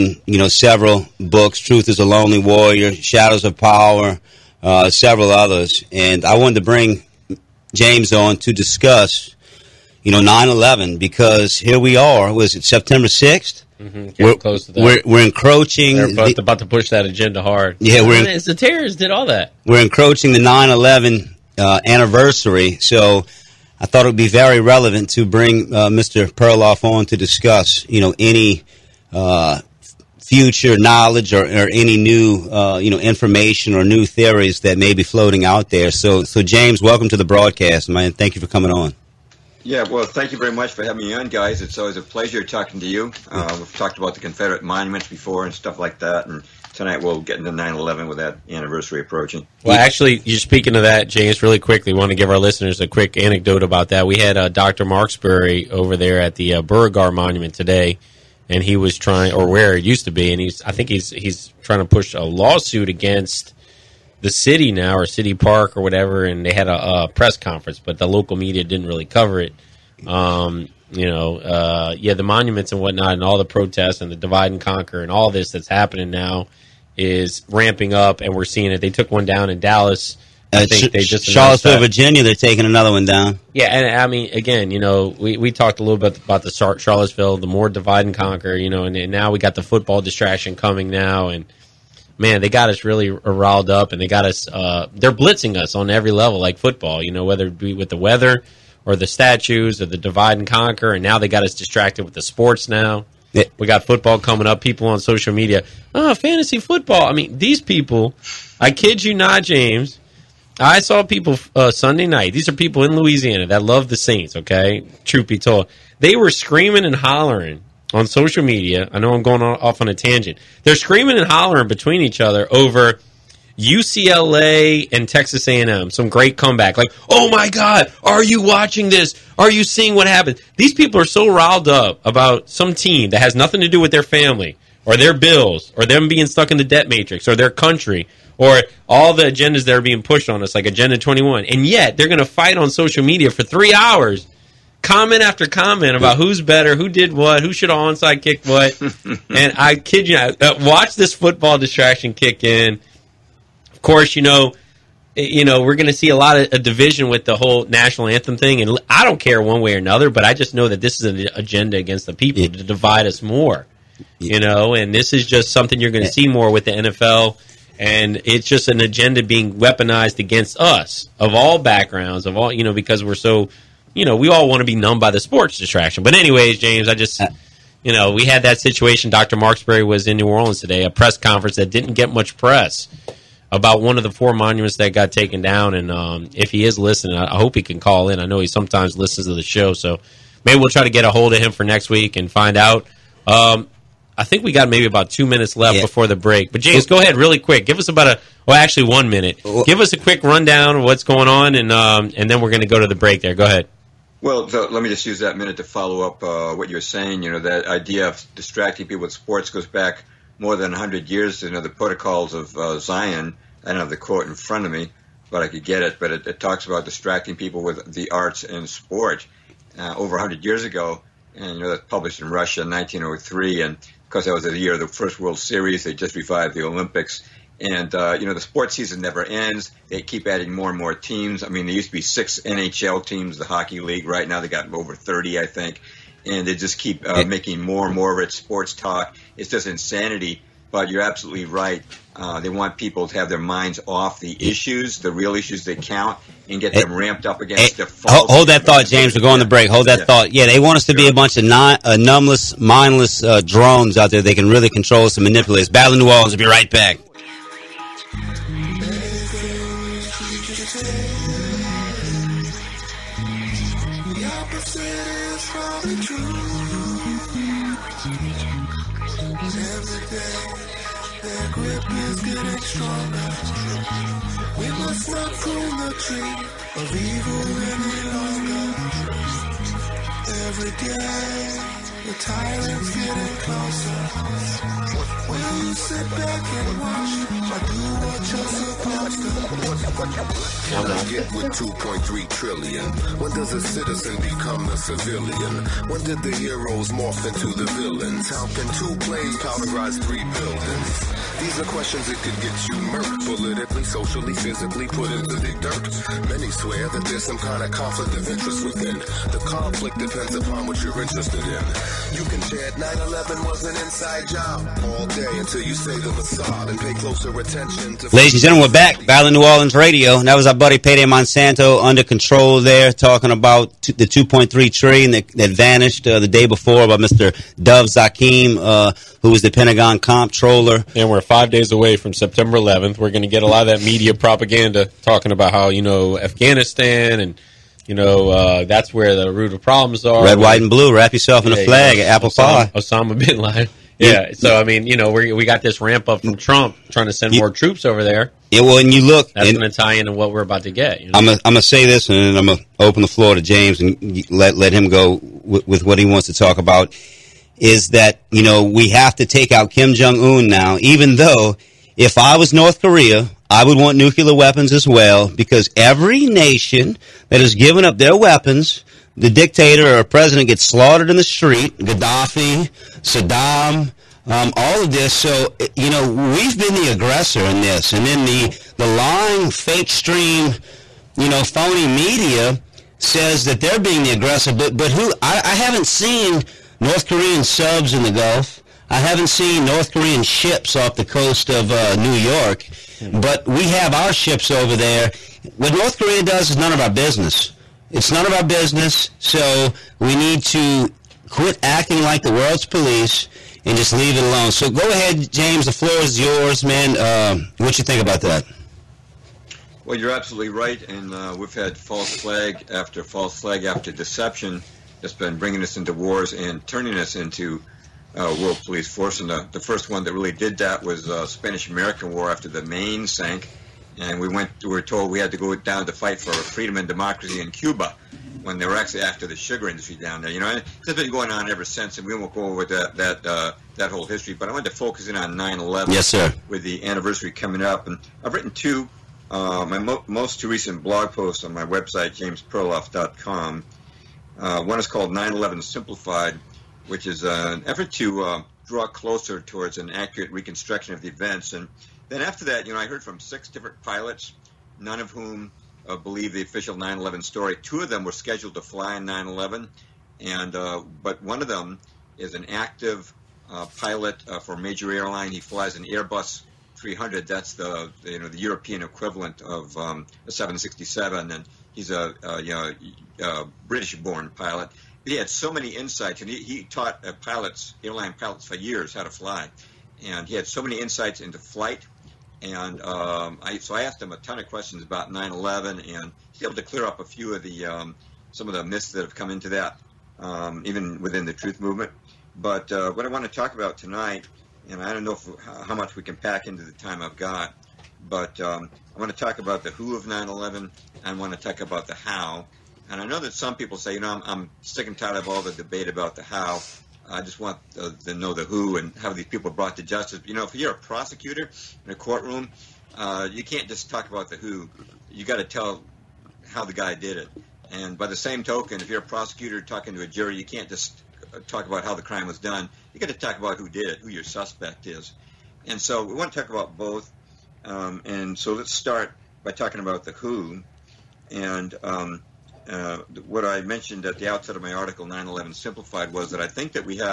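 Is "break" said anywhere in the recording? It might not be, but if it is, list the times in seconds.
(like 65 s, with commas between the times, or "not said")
196 s, 202 s, 249 s.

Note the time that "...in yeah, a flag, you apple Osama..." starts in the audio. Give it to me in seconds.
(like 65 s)
341 s.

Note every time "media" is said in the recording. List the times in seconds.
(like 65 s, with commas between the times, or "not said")
68 s, 105 s, 118 s, 143 s, 333 s, 381 s.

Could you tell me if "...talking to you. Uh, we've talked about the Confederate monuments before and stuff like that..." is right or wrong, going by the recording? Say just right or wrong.
right.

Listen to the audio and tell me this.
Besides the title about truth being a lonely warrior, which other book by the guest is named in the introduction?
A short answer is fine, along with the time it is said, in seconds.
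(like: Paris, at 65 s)
Shadows of Power, at 2 s.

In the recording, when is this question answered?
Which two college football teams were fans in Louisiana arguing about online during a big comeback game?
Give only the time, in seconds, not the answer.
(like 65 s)
123 s.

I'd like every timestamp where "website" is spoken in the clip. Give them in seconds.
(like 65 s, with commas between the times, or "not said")
441 s.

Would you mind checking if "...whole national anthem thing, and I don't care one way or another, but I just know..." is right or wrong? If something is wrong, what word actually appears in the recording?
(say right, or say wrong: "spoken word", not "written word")
right.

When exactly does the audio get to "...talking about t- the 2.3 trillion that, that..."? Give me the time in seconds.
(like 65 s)
322 s.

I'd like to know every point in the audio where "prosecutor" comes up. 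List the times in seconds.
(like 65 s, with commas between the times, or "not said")
510 s, 519 s.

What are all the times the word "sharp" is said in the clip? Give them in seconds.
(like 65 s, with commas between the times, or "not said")
not said.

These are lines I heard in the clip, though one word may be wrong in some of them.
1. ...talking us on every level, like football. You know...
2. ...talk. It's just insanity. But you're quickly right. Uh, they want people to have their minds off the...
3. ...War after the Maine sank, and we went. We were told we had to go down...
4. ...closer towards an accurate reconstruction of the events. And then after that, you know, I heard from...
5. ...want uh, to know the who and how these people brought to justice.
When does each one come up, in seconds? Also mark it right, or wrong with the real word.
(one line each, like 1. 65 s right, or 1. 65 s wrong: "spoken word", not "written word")
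1. 95 s wrong: "blitzing", not "talking"
2. 238 s wrong: "absolutely", not "quickly"
3. 422 s right
4. 448 s right
5. 507 s right.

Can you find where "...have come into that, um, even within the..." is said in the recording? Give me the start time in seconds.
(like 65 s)
489 s.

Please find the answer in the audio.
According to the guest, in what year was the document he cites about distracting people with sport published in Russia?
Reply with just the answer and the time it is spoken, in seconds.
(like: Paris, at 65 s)
1903, at 222 s.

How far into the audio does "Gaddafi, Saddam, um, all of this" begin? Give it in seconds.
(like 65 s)
371 s.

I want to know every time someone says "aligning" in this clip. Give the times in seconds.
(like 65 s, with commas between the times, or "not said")
not said.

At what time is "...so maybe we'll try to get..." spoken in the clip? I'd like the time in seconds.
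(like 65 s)
189 s.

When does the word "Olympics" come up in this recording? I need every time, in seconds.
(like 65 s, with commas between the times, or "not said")
226 s.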